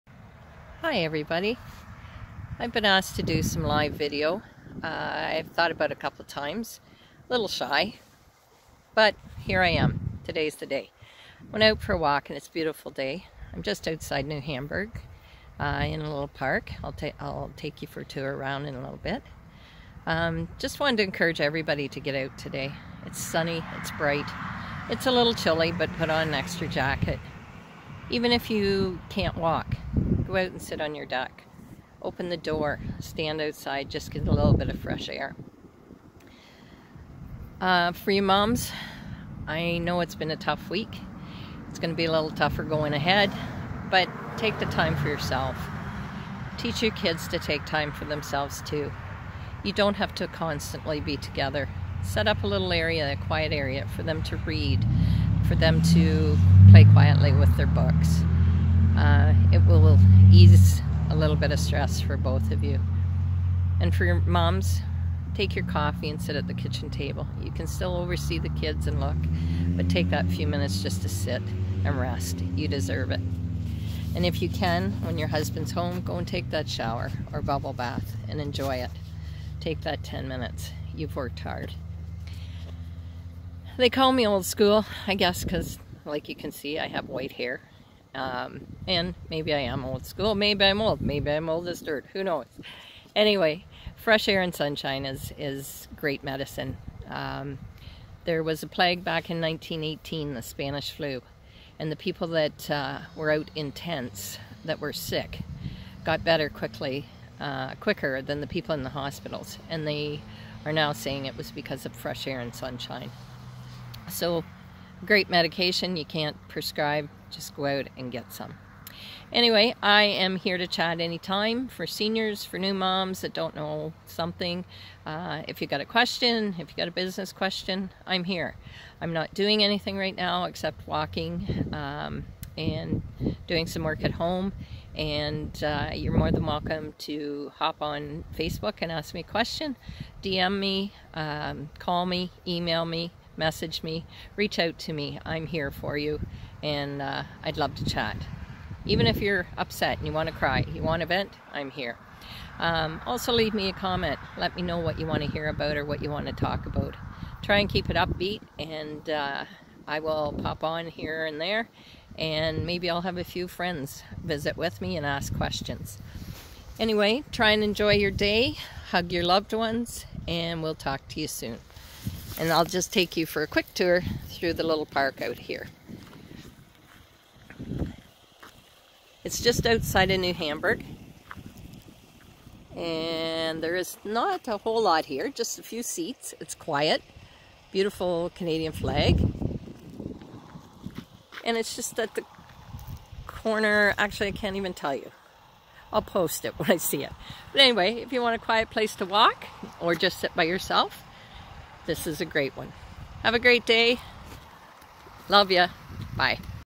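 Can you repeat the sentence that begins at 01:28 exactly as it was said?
Um, and maybe I am old school.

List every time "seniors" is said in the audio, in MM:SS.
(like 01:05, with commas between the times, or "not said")
02:01.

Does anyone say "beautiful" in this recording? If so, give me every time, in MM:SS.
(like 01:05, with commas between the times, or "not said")
00:12, 03:07.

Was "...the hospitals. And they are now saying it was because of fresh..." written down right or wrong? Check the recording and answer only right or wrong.
right.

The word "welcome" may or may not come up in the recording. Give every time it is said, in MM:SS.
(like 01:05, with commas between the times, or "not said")
02:16.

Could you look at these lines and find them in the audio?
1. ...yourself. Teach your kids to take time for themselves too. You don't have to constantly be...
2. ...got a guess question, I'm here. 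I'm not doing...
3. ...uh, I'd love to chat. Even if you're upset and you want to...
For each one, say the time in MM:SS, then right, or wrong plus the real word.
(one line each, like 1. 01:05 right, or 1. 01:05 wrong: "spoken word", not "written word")
1. 00:45 right
2. 02:06 wrong: "business", not "guess"
3. 02:27 right.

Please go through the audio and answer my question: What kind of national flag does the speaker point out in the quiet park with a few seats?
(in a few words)
Canadian flag.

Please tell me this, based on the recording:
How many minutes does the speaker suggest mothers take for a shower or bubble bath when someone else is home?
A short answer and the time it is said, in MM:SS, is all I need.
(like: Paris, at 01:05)
10, at 01:20.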